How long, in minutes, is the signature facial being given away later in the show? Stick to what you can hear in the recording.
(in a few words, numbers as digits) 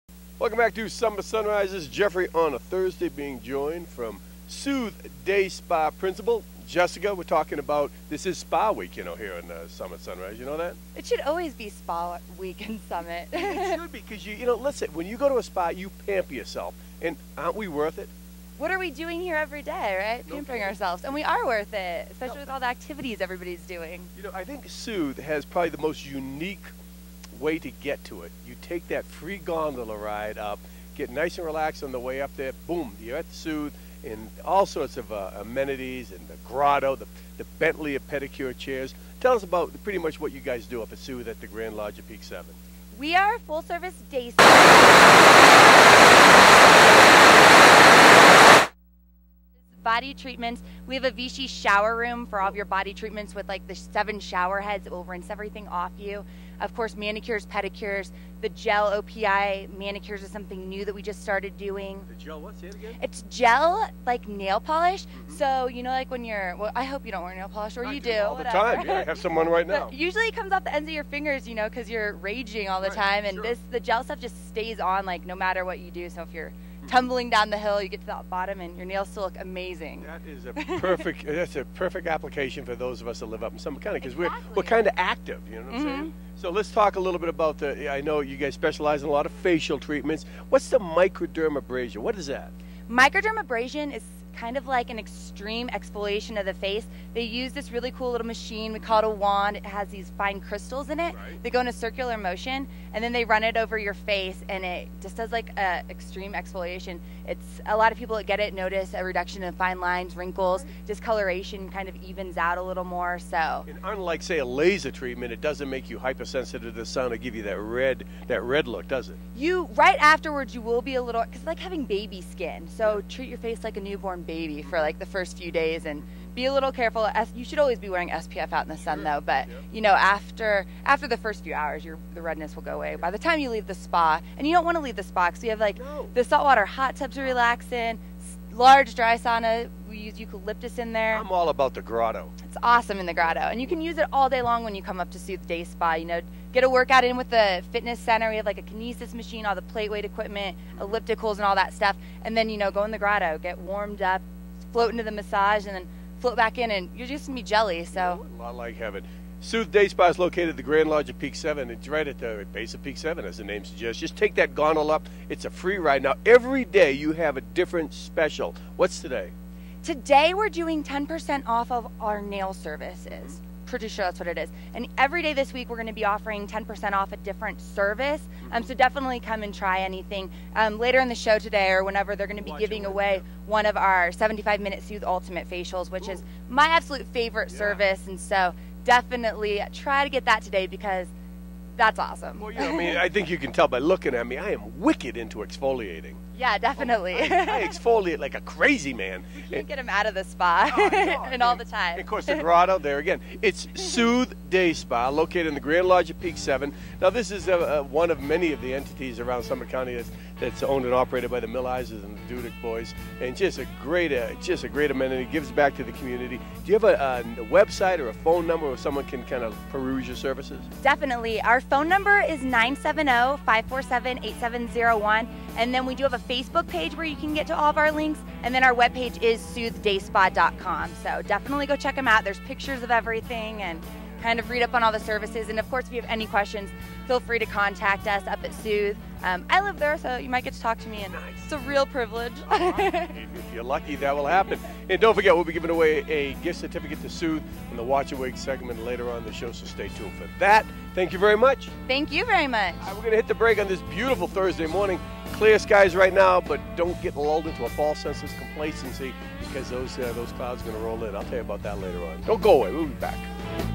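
75.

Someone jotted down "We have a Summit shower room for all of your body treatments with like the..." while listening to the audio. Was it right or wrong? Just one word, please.
wrong.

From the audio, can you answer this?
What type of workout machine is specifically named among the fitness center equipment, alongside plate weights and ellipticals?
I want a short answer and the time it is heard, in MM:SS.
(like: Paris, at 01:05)
kinesis machine, at 02:28.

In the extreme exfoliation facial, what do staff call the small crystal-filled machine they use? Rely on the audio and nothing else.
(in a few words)
wand.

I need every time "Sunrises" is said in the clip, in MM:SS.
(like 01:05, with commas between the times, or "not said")
00:01, 00:10.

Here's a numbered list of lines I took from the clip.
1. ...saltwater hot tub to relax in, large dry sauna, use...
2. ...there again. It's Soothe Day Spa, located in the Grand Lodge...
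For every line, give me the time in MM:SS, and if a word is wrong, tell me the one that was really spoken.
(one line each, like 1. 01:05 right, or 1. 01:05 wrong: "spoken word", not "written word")
1. 02:16 right
2. 03:22 right.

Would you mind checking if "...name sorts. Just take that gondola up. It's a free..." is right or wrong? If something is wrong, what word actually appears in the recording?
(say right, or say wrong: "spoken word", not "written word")
wrong: "suggests", not "sorts".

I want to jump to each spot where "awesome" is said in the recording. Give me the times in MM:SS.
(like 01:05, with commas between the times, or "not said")
02:22, 03:11.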